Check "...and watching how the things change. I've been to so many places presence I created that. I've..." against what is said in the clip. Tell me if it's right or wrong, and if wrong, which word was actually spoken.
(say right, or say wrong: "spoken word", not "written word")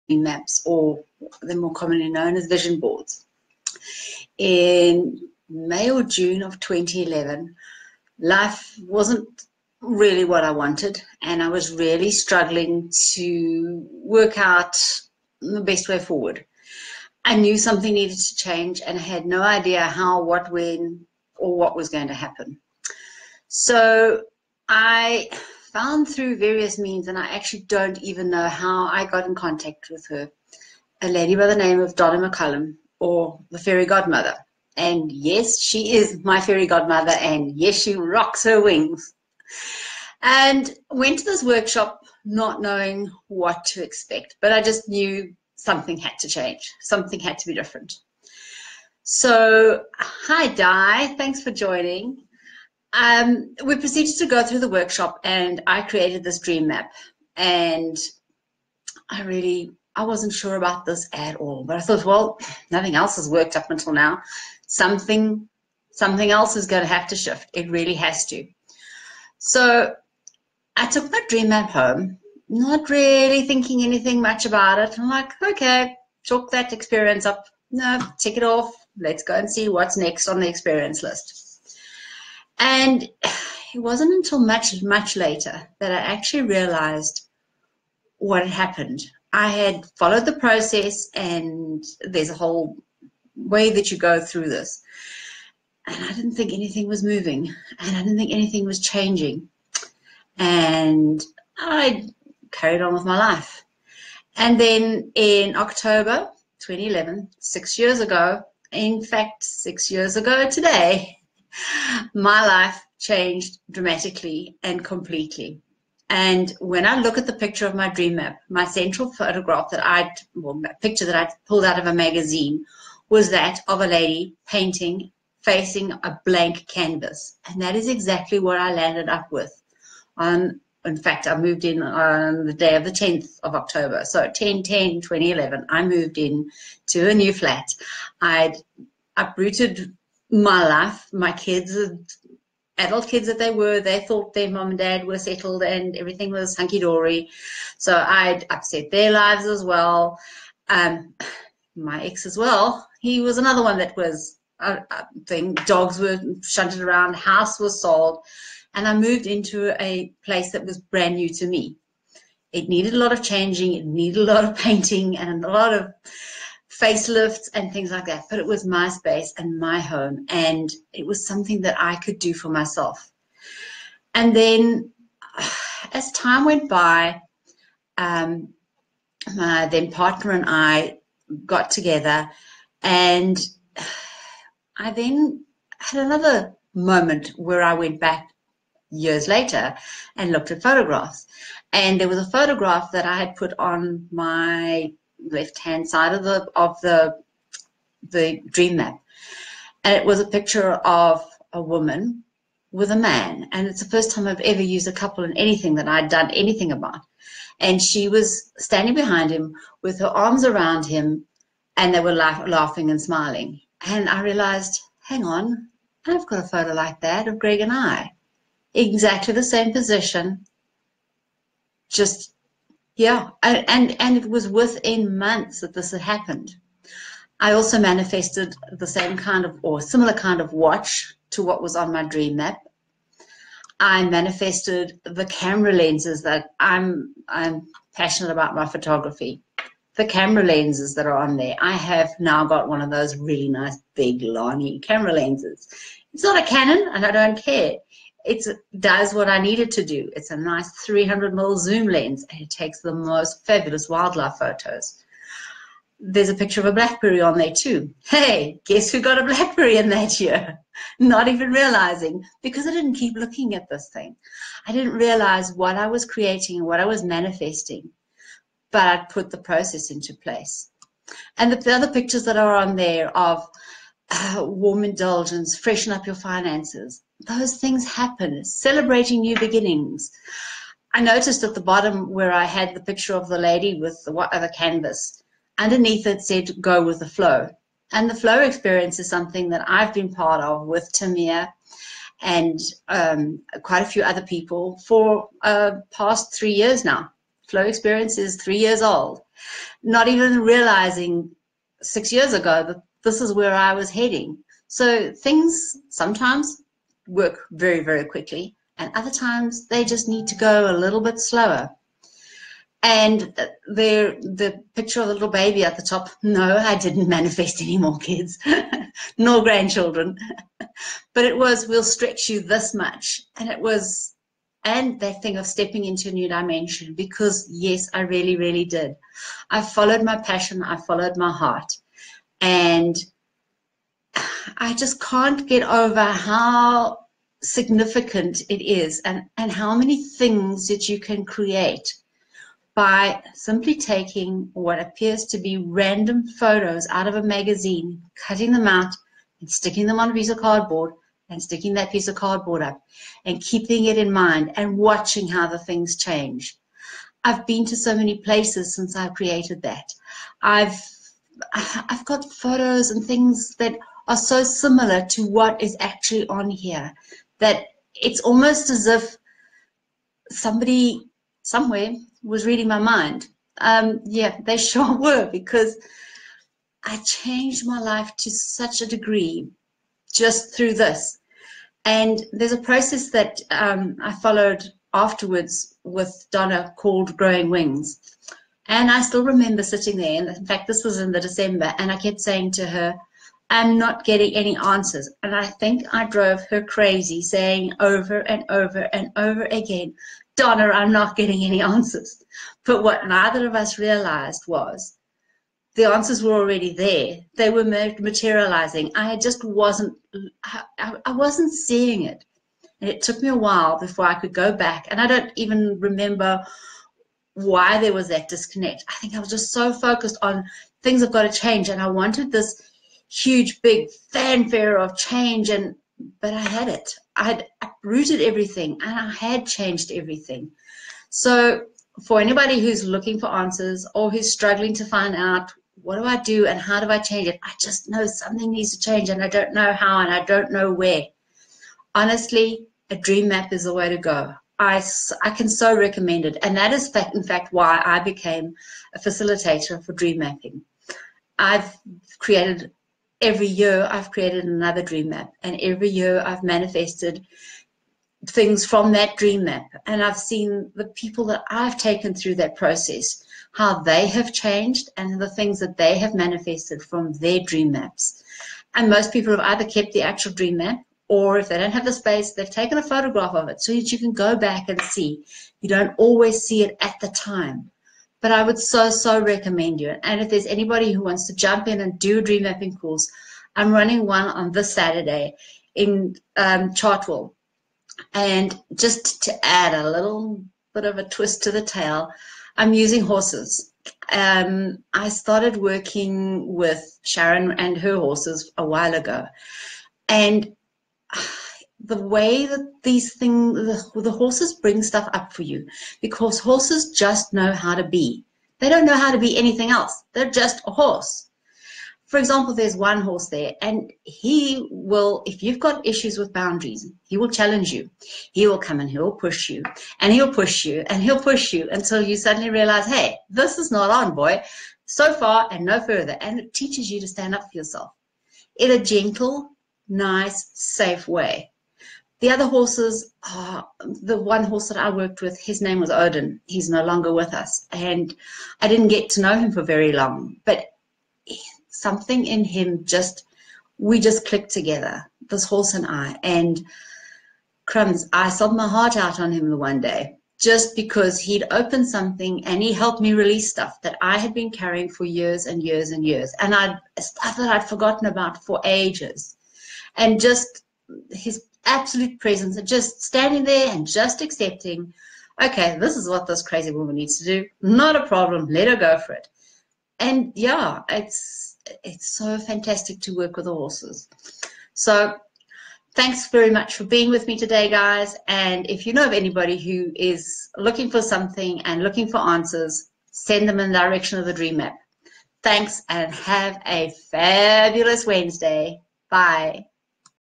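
wrong: "since", not "presence".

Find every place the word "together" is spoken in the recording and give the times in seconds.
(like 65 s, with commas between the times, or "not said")
181 s, 544 s.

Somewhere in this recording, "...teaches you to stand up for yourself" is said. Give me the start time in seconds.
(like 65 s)
526 s.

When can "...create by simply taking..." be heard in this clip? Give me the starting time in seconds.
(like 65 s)
341 s.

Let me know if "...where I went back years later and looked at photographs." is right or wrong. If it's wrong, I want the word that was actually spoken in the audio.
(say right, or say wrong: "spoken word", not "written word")
right.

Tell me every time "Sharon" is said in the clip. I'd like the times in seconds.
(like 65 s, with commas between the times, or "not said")
497 s.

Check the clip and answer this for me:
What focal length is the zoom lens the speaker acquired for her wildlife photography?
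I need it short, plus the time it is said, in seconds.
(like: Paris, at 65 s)
300 mm, at 250 s.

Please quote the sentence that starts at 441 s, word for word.
Honestly, a dream map is the way to go.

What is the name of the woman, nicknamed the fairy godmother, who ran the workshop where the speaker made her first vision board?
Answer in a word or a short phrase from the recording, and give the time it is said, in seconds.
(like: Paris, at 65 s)
Donna McCullum, at 31 s.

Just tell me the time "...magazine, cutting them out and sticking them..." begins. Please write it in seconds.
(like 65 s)
347 s.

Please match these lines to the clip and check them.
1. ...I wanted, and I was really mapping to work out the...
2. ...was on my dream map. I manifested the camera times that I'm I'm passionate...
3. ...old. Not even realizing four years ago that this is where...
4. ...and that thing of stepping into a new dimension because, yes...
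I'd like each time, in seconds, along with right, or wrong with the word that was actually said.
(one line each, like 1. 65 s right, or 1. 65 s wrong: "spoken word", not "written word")
1. 10 s wrong: "struggling", not "mapping"
2. 231 s wrong: "lenses", not "times"
3. 298 s wrong: "six", not "four"
4. 324 s right.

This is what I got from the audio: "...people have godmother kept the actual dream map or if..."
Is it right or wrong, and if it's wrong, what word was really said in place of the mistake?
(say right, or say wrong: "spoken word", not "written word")
wrong: "either", not "godmother".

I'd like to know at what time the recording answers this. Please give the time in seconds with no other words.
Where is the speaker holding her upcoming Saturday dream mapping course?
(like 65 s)
486 s.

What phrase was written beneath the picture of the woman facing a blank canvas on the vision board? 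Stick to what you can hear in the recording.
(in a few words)
Go with the flow.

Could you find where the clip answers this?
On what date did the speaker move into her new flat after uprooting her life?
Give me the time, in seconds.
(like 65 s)
132 s.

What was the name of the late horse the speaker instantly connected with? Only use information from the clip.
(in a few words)
Odin.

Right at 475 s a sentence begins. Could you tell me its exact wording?
You don't always see it at the time.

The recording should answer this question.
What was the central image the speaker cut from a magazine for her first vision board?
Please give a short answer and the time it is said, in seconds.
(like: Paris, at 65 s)
A lady painting, at 123 s.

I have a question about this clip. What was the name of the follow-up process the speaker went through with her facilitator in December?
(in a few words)
Growing Wings.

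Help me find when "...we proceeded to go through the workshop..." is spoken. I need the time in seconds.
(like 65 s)
53 s.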